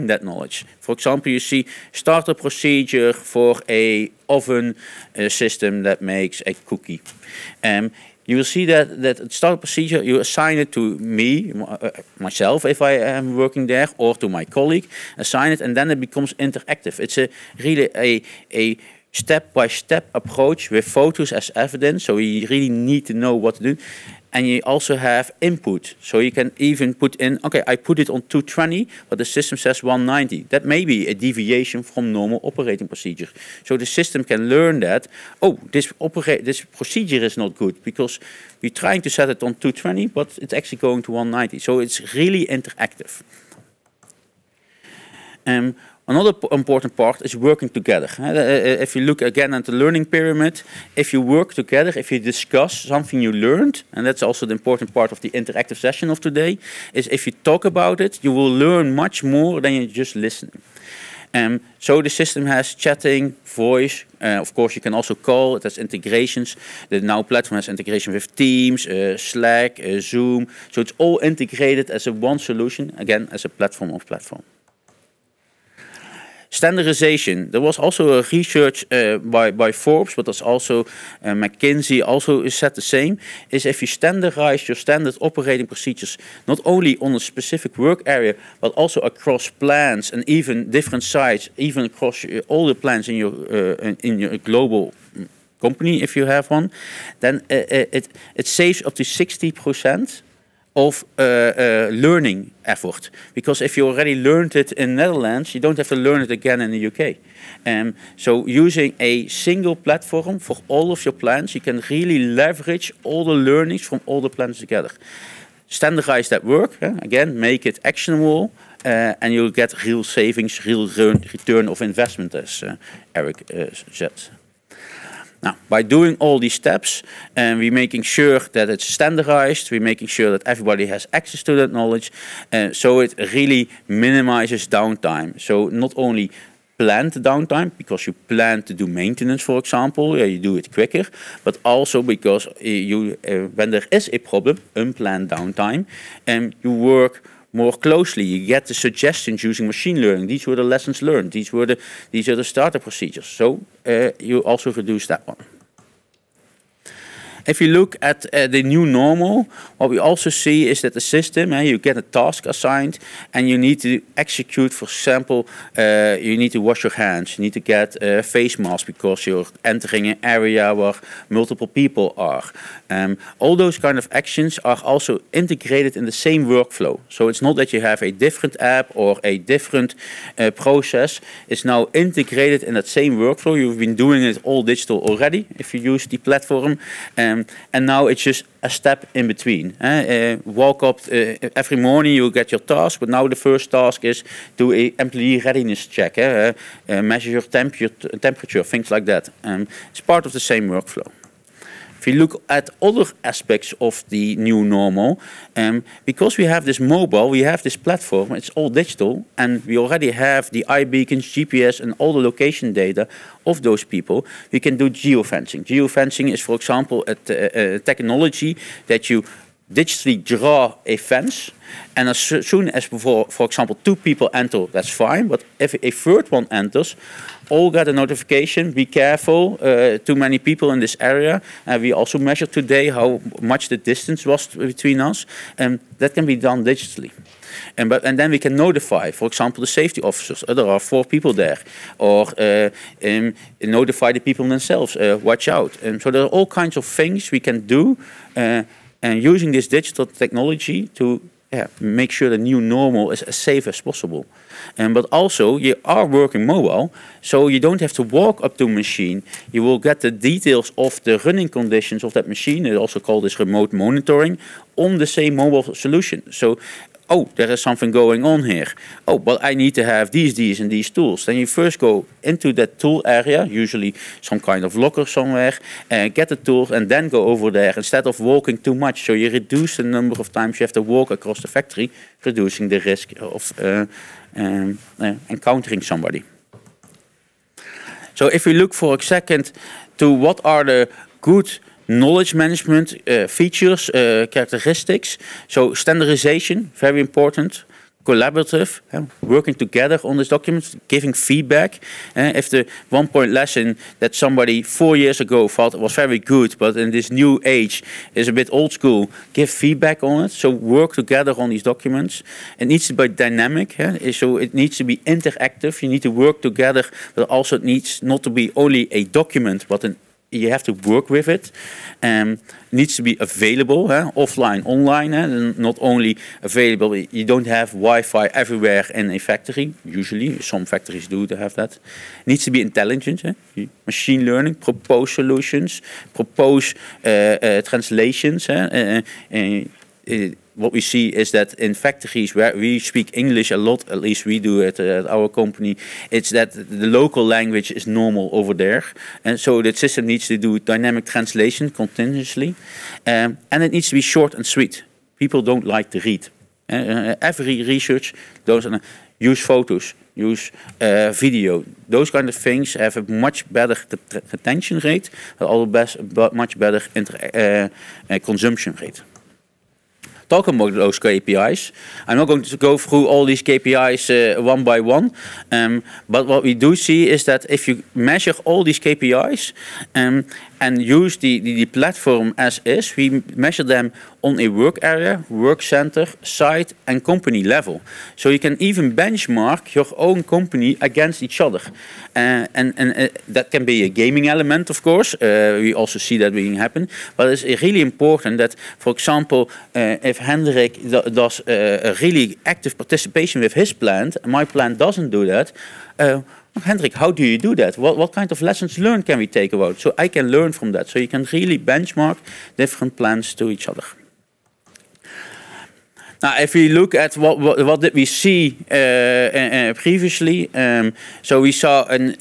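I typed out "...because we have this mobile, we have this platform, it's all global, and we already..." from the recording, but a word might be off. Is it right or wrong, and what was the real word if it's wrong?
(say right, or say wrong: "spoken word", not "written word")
wrong: "digital", not "global".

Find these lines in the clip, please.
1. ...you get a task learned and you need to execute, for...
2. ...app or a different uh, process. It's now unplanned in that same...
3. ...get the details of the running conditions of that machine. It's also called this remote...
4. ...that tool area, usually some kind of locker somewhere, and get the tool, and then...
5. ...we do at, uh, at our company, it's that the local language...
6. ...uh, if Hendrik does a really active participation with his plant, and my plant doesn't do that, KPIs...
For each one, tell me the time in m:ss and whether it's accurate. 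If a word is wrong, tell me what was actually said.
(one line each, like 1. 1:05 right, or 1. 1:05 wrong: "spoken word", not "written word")
1. 2:41 wrong: "assigned", not "learned"
2. 2:58 wrong: "integrated", not "unplanned"
3. 4:19 right
4. 4:32 right
5. 5:44 right
6. 6:39 wrong: "Hendrik", not "KPIs".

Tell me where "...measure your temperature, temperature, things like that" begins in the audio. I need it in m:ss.
3:17.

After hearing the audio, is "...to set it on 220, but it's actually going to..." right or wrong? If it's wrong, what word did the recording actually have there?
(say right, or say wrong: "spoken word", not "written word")
right.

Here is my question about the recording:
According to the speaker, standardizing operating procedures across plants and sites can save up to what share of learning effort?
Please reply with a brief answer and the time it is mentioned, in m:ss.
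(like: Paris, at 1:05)
60%, at 1:39.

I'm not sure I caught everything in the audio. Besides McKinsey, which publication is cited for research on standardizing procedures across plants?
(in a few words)
Forbes.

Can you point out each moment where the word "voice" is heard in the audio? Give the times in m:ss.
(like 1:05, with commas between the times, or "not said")
1:03.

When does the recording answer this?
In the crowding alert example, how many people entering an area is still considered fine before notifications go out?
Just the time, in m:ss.
3:43.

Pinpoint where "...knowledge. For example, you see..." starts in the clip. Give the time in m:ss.
0:00.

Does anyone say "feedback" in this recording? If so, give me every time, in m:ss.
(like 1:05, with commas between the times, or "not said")
5:01, 5:09.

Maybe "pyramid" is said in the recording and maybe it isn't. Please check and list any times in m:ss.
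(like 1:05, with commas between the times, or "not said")
0:50.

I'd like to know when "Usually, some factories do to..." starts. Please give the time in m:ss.
5:29.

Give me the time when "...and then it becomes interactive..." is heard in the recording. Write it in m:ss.
0:15.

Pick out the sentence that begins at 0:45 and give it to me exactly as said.
Um, another important part is working together.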